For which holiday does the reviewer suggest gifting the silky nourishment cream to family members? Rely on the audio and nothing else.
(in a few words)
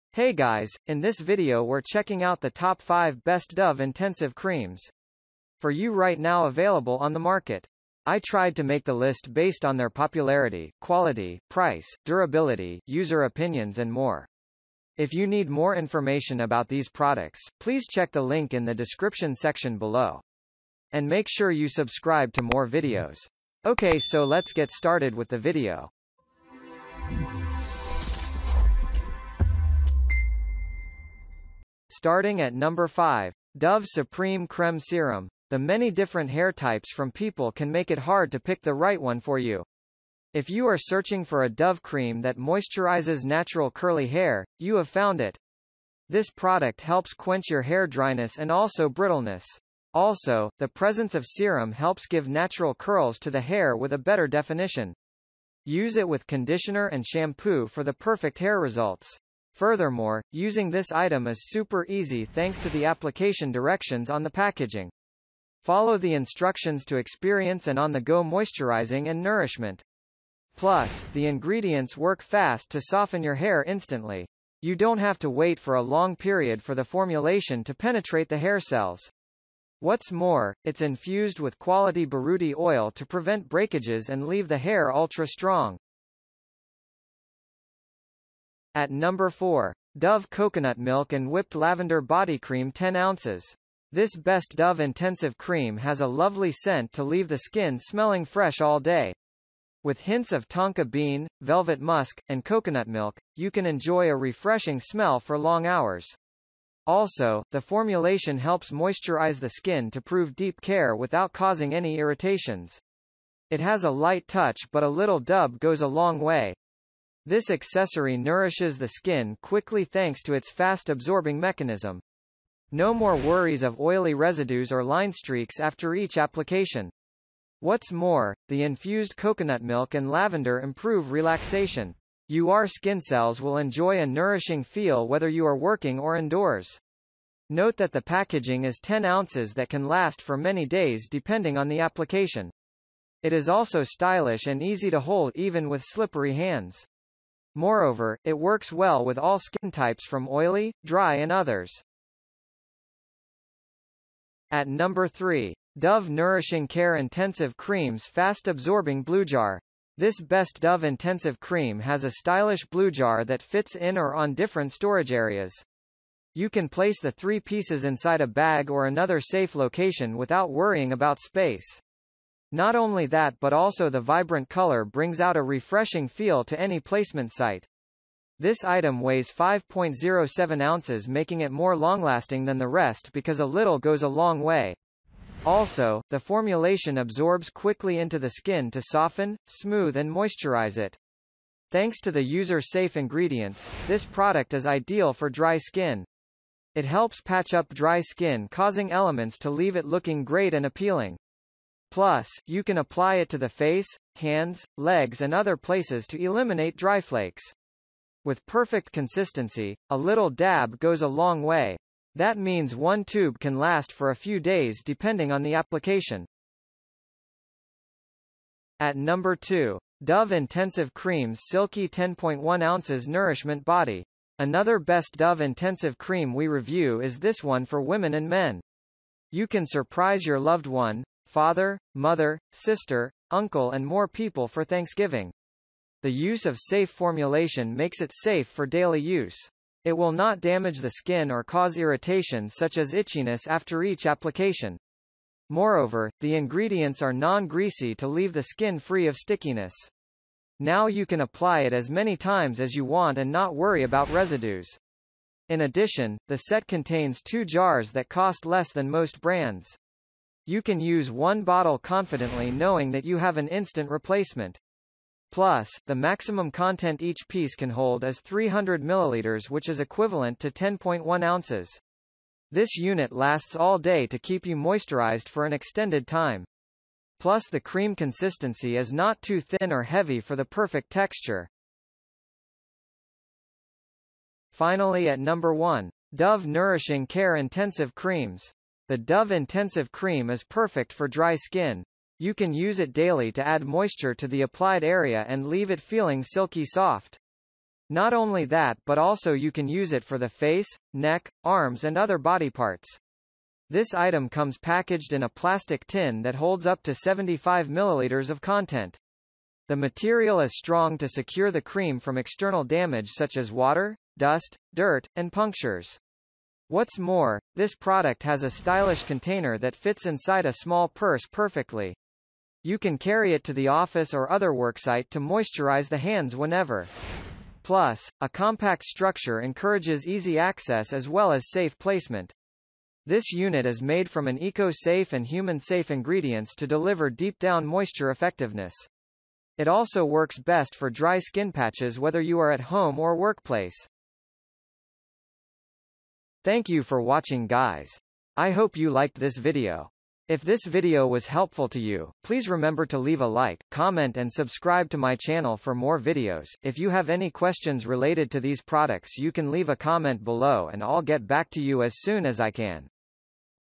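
Thanksgiving.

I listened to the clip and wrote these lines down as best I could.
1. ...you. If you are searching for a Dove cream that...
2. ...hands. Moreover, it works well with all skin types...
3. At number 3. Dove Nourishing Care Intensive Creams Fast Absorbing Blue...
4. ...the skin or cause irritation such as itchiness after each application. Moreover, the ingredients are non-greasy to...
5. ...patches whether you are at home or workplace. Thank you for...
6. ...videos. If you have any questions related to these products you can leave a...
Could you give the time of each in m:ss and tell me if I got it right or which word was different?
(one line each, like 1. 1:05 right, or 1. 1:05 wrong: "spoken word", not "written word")
1. 0:39 right
2. 2:26 right
3. 2:34 right
4. 4:00 right
5. 5:41 right
6. 5:55 right.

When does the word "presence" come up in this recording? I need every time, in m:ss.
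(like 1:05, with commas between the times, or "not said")
0:50.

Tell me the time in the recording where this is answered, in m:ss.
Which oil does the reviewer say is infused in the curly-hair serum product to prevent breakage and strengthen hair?
1:22.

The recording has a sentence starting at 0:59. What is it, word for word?
Furthermore, using this item is super easy thanks to the application directions on the packaging.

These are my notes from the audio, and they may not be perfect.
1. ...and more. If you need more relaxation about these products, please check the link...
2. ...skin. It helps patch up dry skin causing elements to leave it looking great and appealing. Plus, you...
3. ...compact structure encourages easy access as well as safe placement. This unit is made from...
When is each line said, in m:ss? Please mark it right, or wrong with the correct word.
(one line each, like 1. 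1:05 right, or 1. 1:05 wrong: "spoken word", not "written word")
1. 0:13 wrong: "information", not "relaxation"
2. 3:15 right
3. 5:28 right.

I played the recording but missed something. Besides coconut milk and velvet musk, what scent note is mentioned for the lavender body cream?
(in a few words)
tonka bean.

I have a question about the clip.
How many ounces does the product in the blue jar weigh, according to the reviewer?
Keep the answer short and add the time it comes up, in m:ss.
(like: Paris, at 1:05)
5.07 ounces, at 2:59.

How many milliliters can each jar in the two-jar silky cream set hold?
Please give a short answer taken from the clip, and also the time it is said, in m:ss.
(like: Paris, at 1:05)
300 milliliters, at 4:28.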